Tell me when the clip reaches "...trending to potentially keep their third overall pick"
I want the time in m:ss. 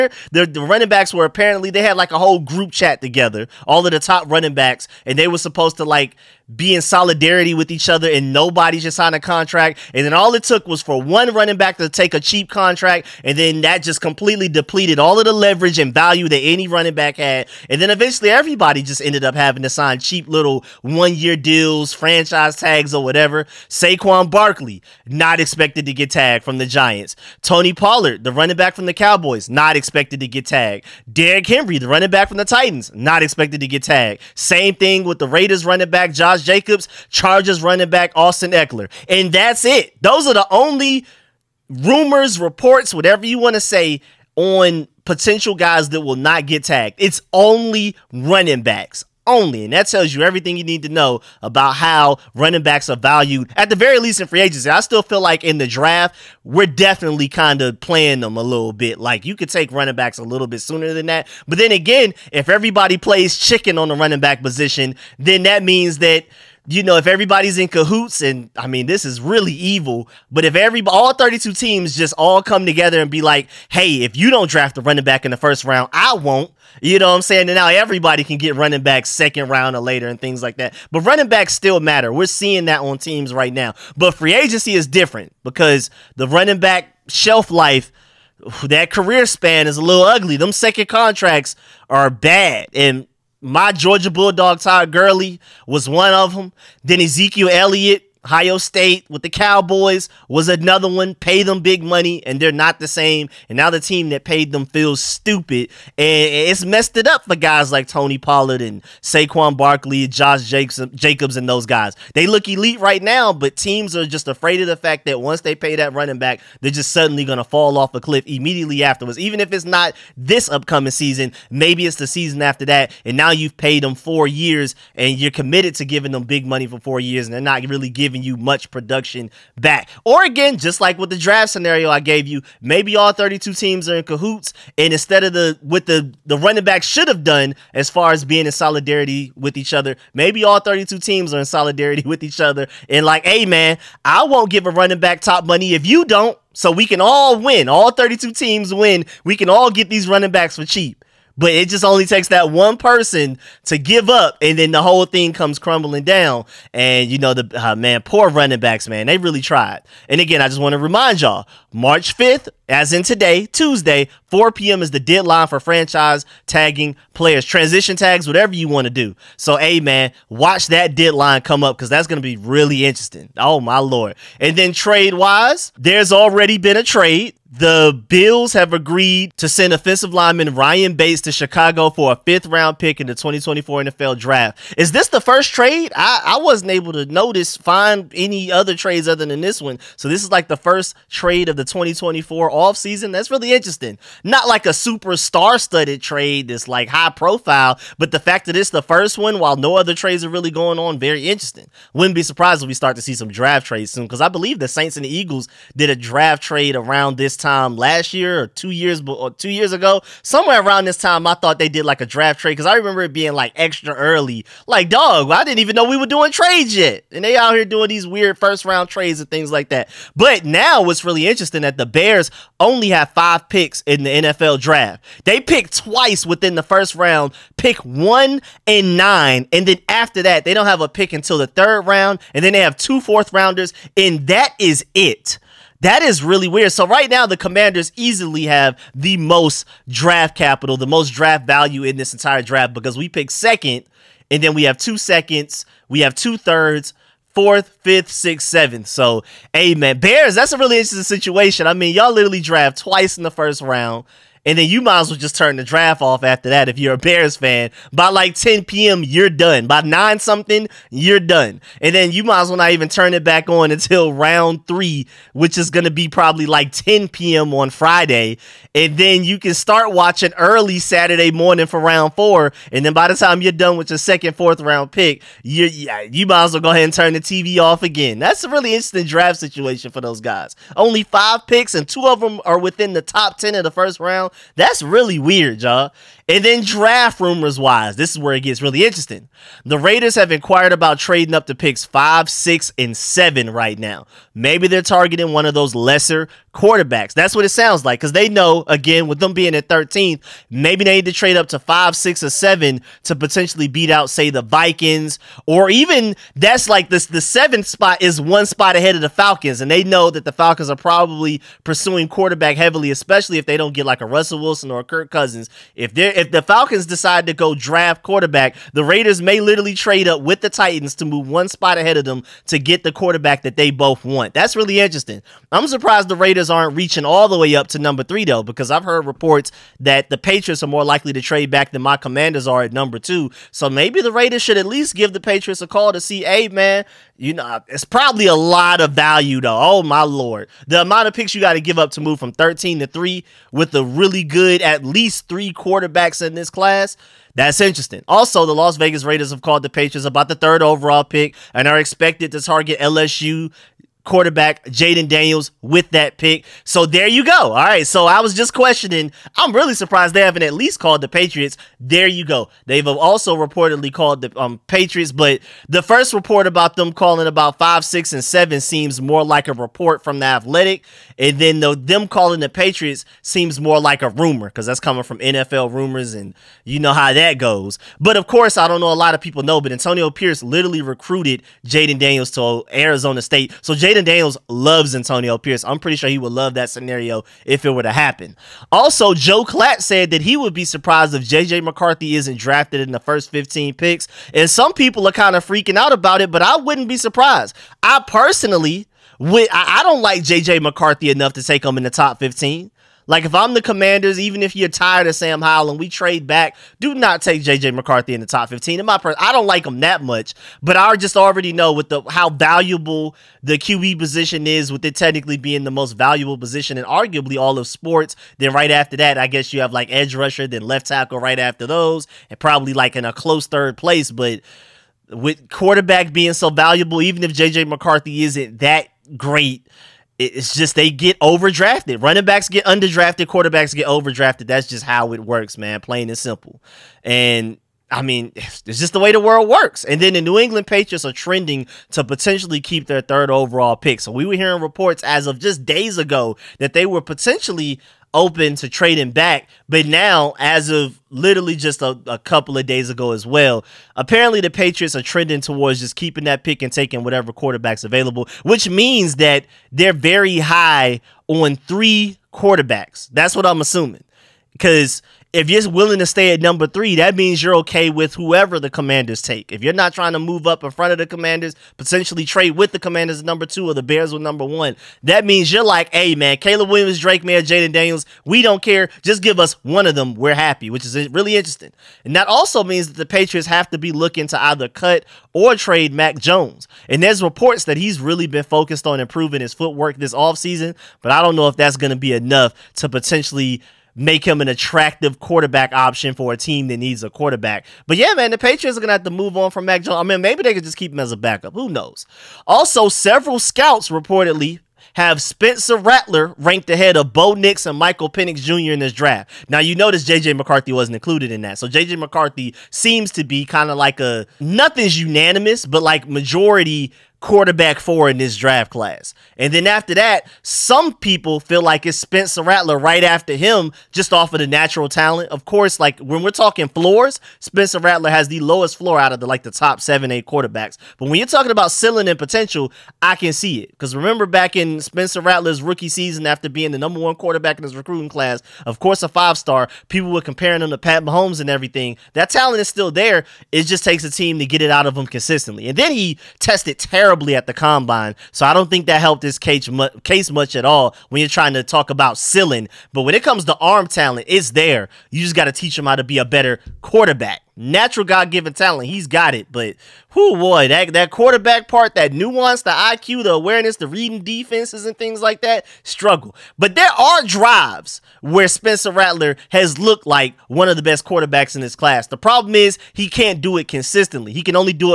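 7:21.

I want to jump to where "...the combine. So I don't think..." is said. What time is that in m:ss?
9:07.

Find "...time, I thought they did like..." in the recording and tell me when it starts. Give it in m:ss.
3:30.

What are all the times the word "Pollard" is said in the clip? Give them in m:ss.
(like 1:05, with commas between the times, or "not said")
0:27, 1:48.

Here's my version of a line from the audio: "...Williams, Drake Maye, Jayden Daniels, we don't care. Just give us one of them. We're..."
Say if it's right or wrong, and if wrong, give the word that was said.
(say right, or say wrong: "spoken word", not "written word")
right.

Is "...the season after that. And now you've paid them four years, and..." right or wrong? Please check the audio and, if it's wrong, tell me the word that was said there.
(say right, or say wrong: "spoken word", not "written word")
right.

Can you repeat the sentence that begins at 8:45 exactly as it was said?
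Of course, like when we're talking floors, Spencer Rattler has the lowest floor out of the like the top seven, eight quarterbacks.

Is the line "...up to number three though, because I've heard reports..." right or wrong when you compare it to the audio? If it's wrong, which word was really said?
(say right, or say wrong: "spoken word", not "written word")
right.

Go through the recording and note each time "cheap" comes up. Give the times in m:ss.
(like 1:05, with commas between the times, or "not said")
0:12, 0:19, 2:30.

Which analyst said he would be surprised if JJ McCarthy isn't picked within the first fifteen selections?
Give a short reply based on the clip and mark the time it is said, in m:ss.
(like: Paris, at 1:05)
Joel Klatt, at 6:29.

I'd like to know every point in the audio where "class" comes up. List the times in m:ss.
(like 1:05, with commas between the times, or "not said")
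5:46, 8:38, 8:58, 9:31.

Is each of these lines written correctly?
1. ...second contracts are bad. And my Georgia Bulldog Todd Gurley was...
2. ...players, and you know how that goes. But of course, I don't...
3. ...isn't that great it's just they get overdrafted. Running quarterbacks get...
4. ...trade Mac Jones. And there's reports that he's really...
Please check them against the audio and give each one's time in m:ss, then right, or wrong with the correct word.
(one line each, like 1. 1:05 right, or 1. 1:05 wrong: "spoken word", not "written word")
1. 1:30 right
2. 6:15 wrong: "rumors", not "players"
3. 7:08 wrong: "backs", not "quarterbacks"
4. 8:05 right.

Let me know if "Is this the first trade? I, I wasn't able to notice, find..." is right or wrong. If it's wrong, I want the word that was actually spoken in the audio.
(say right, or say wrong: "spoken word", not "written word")
right.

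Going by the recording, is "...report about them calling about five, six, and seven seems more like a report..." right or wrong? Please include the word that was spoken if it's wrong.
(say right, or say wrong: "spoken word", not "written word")
right.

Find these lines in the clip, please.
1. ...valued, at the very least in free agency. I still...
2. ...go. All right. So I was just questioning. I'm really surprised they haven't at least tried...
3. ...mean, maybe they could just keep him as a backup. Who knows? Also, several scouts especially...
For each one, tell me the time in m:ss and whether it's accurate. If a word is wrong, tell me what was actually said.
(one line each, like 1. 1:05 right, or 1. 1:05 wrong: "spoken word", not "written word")
1. 0:52 right
2. 5:57 wrong: "called", not "tried"
3. 8:20 wrong: "reportedly", not "especially".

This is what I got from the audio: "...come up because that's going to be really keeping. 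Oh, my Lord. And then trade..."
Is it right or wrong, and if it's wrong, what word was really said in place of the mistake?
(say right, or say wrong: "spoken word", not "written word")
wrong: "interesting", not "keeping".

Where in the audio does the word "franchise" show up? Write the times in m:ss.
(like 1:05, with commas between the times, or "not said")
0:21, 2:45.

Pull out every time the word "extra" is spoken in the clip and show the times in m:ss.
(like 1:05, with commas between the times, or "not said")
3:33.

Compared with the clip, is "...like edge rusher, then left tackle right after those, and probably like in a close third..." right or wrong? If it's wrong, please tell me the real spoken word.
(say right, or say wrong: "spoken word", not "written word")
right.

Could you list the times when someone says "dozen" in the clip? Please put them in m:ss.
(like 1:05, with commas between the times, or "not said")
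not said.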